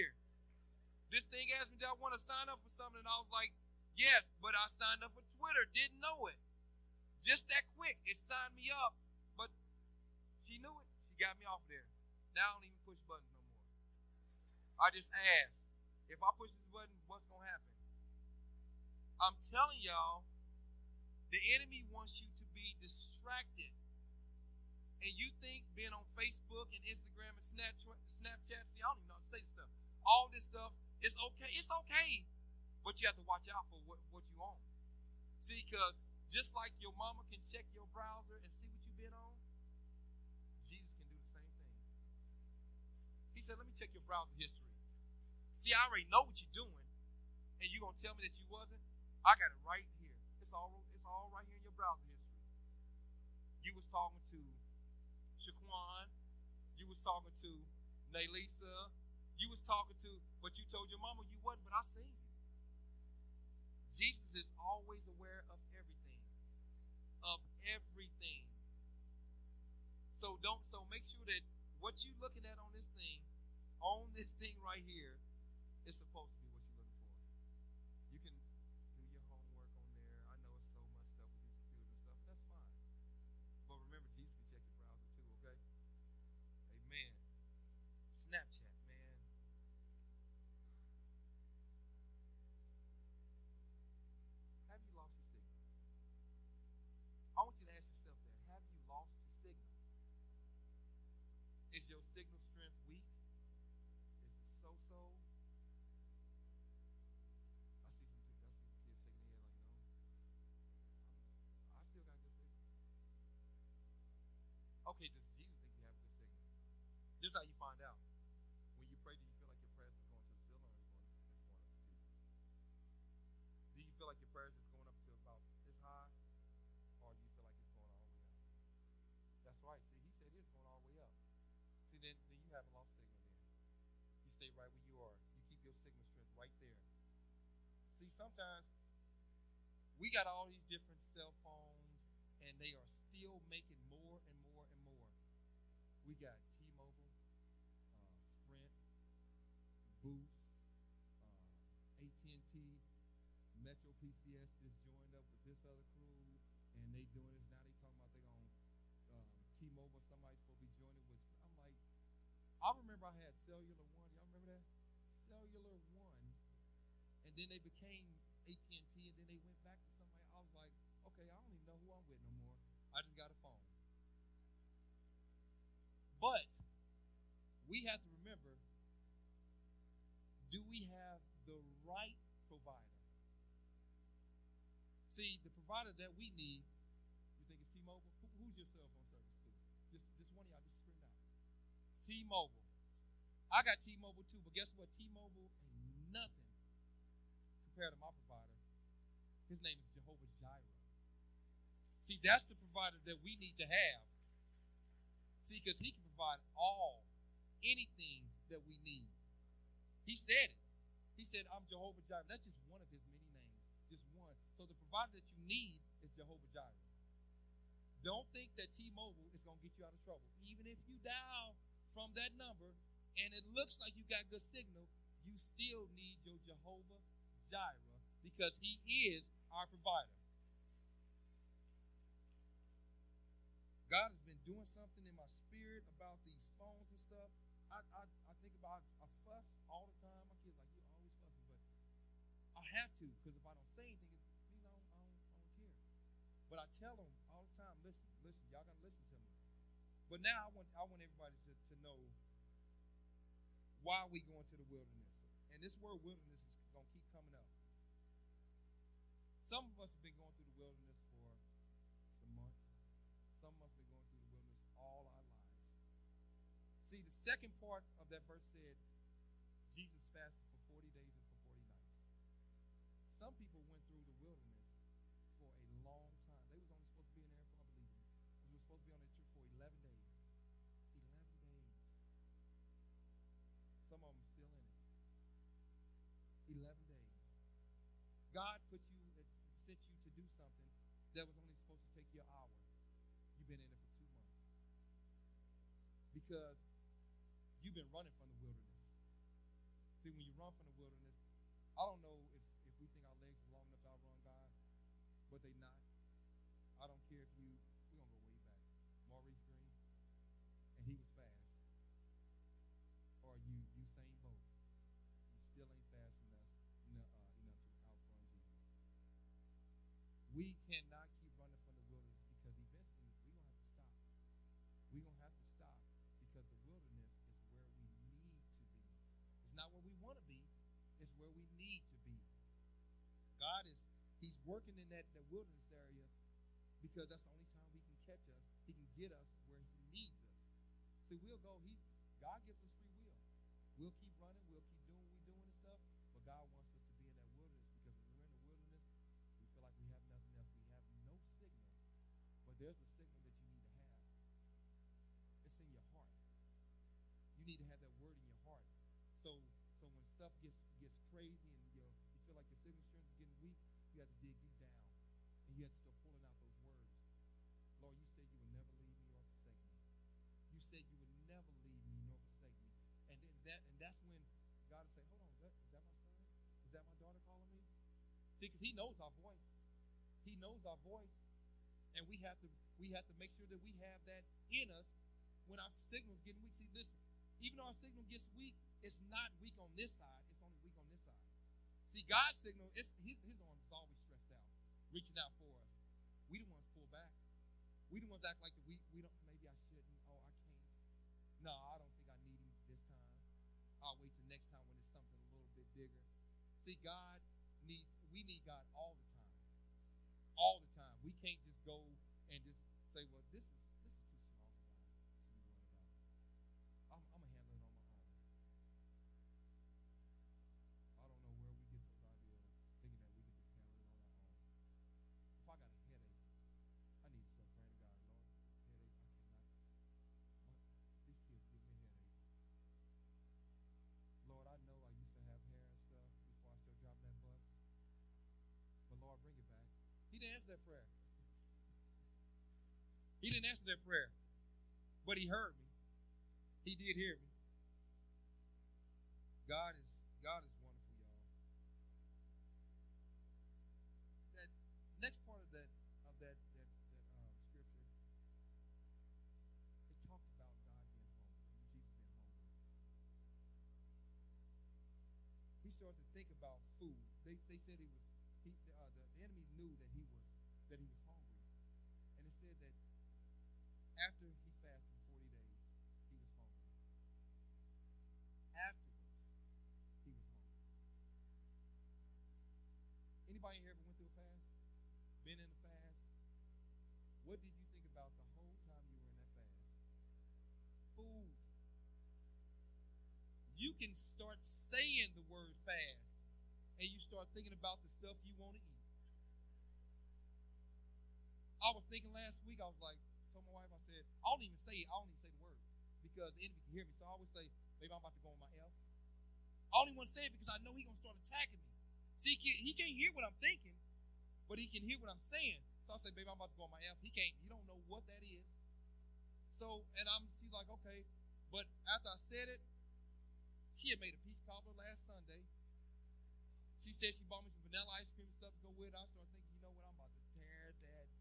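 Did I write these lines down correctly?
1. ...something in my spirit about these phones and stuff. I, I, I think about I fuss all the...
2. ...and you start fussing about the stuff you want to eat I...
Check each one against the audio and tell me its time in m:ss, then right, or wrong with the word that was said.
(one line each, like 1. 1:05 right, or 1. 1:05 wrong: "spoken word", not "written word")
1. 3:54 right
2. 8:16 wrong: "thinking", not "fussing".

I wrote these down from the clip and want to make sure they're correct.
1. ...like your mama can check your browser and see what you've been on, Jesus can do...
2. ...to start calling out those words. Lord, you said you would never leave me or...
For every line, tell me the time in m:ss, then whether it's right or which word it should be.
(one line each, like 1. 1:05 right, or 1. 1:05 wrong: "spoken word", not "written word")
1. 0:36 right
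2. 6:05 wrong: "pulling", not "calling".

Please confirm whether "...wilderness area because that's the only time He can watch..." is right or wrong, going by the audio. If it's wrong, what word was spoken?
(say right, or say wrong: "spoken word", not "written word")
wrong: "catch", not "watch".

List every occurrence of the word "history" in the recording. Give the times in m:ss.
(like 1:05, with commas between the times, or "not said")
0:44, 0:52.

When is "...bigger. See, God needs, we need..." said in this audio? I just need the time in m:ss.
6:45.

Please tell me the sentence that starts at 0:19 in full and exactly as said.
I'm telling y'all, the enemy wants you to be distracted.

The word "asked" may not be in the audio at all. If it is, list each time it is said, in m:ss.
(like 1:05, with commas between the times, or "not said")
0:01.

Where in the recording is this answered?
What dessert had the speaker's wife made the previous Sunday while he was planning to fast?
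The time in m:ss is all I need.
8:44.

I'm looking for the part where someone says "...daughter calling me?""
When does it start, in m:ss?
6:17.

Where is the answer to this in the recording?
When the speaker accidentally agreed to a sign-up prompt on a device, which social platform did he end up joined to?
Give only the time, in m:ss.
0:05.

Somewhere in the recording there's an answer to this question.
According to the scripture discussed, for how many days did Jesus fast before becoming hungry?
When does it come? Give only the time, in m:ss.
7:55.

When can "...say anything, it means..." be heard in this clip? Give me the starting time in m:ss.
4:03.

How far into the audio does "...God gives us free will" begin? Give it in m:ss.
5:42.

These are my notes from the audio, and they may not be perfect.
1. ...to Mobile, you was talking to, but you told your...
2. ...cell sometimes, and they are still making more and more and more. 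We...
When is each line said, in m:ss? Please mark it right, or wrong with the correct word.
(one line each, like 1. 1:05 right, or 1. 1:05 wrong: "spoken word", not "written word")
1. 0:57 wrong: "Naylisa", not "Mobile"
2. 2:21 wrong: "phones", not "sometimes".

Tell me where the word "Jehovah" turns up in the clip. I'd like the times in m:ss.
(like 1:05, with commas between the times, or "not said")
3:19, 3:31, 3:36, 3:46.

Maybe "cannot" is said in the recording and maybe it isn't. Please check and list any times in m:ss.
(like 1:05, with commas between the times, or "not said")
5:20.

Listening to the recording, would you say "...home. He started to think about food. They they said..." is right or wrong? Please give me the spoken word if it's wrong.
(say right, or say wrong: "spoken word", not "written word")
right.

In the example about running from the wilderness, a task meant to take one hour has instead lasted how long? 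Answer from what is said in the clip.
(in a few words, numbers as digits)
2 months.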